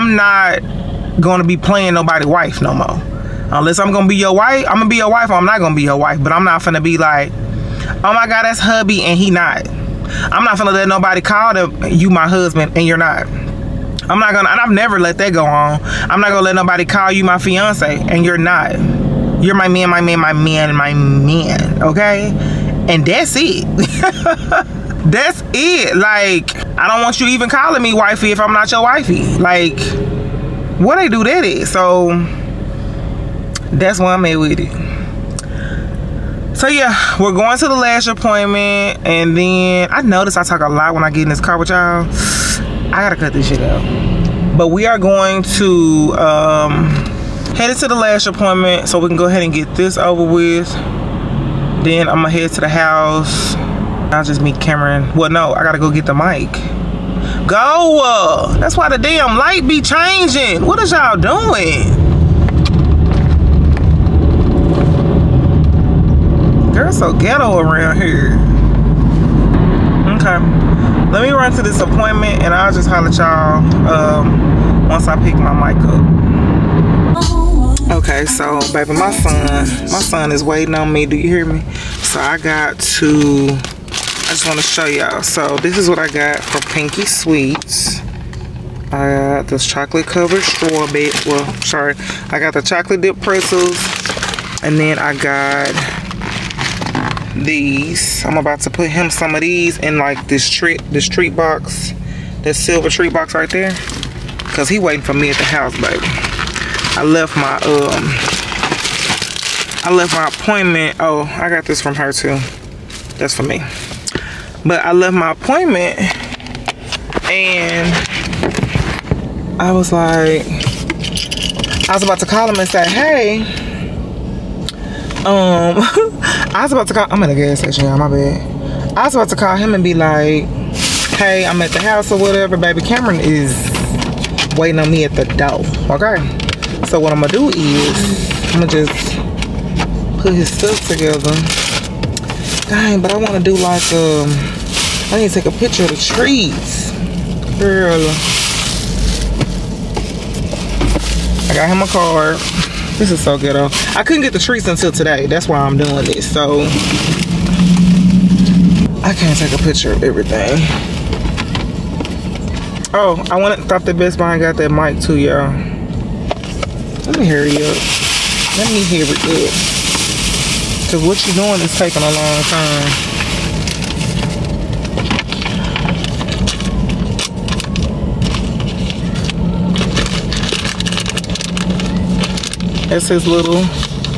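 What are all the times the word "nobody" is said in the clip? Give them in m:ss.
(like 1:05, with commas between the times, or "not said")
0:01, 0:10, 0:16.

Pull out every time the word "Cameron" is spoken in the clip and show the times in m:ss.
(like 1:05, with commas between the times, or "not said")
0:54, 2:12.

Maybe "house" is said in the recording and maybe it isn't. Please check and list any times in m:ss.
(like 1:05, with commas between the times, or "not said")
0:52, 1:45, 2:11.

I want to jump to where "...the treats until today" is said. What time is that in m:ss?
2:34.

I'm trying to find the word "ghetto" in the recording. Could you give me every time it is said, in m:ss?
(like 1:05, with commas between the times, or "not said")
1:07, 2:33.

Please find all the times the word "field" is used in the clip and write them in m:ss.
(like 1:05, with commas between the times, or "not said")
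not said.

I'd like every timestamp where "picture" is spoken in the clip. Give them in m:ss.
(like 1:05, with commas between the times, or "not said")
2:25, 2:39.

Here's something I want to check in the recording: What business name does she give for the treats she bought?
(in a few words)
Pinky Sweets.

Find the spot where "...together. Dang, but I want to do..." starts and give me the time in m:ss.
2:20.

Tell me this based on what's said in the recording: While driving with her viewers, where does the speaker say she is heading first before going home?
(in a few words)
Lash appointment.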